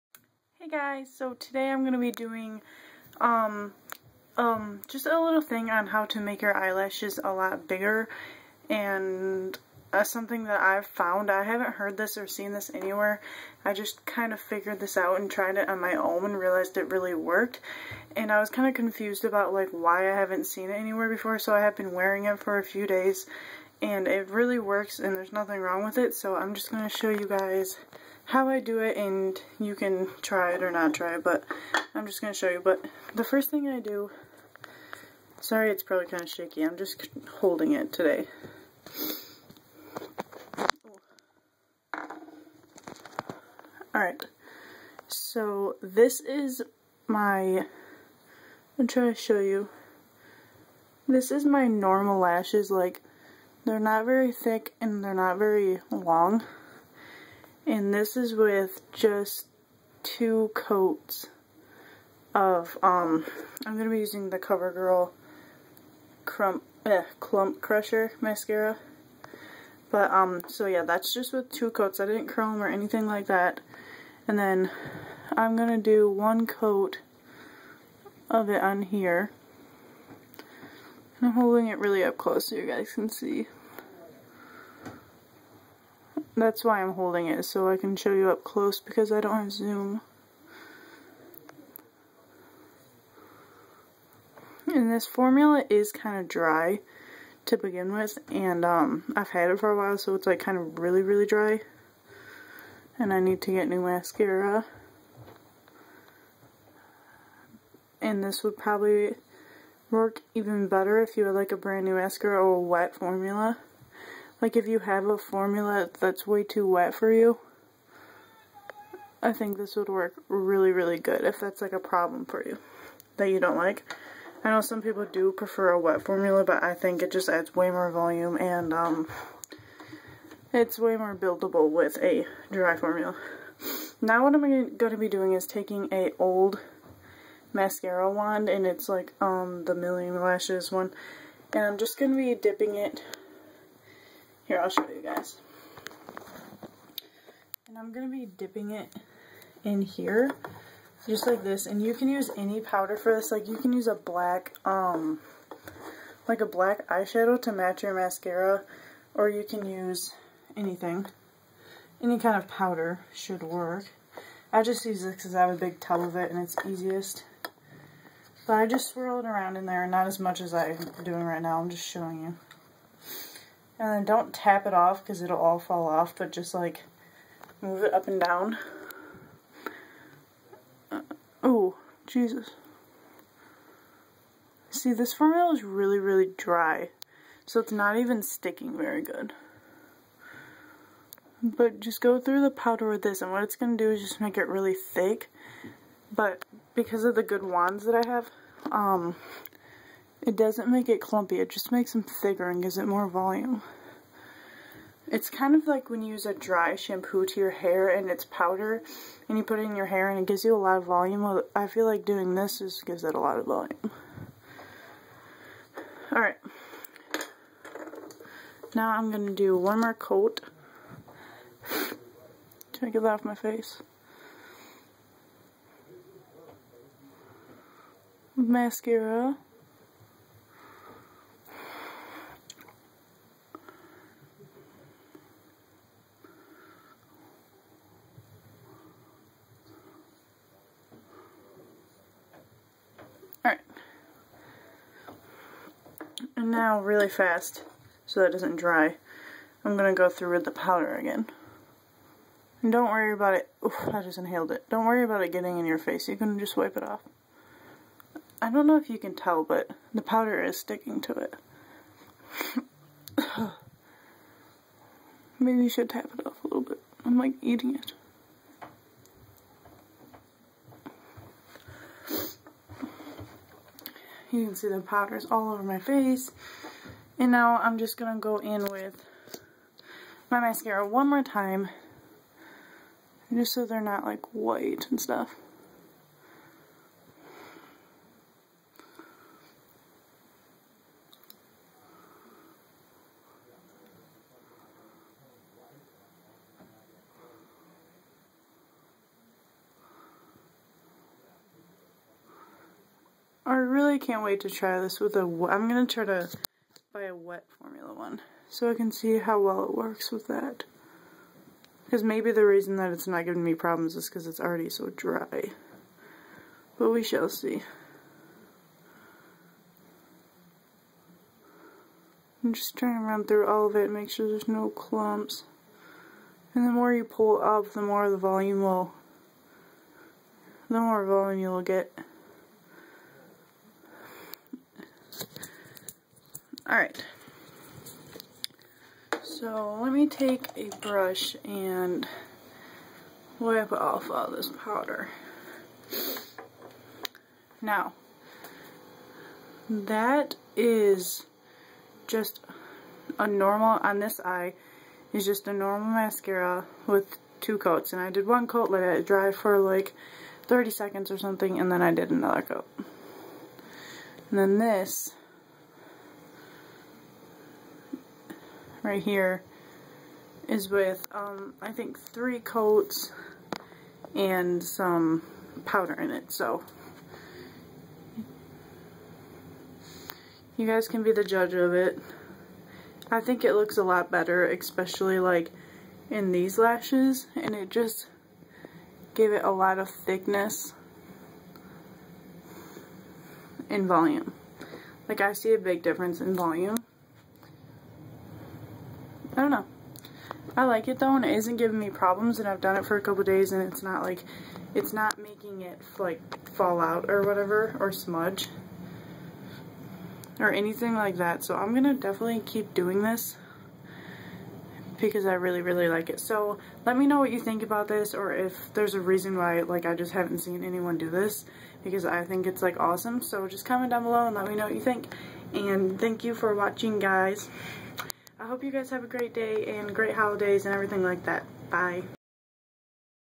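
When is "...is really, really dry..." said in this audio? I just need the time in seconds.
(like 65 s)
185 s.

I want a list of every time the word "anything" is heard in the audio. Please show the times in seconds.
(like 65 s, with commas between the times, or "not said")
72 s, 160 s, 410 s.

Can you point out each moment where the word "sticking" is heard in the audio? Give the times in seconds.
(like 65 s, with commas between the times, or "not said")
188 s, 260 s.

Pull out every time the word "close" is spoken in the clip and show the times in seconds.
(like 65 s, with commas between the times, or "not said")
82 s, 88 s.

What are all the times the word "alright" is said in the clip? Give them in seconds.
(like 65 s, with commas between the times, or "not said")
43 s, 216 s.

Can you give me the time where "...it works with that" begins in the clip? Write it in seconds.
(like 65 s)
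309 s.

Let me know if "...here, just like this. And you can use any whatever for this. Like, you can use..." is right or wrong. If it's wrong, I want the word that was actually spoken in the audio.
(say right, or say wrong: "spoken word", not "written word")
wrong: "powder", not "whatever".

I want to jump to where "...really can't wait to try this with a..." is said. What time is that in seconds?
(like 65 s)
303 s.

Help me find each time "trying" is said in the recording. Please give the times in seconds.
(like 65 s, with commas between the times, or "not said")
48 s, 322 s.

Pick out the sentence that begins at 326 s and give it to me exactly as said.
And the more you pull up, the more the volume will, the more volume you'll get.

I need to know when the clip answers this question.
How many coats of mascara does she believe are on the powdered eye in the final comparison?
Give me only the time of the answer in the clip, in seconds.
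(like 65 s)
371 s.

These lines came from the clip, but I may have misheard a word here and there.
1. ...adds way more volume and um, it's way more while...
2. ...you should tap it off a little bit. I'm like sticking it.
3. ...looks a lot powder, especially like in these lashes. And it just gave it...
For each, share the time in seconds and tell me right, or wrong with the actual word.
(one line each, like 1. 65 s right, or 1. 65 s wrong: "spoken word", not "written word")
1. 127 s wrong: "buildable", not "while"
2. 265 s wrong: "eating", not "sticking"
3. 383 s wrong: "better", not "powder".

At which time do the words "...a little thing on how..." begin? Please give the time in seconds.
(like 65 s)
5 s.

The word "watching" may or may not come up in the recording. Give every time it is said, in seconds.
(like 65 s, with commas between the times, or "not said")
426 s.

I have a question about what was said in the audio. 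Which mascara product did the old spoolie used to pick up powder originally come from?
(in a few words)
Million Lashes.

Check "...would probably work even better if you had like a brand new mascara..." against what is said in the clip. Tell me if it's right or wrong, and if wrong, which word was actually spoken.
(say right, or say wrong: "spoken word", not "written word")
right.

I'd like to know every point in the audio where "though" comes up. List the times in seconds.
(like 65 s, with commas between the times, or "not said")
400 s.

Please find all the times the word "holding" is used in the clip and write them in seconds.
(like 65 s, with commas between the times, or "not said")
37 s, 81 s, 86 s.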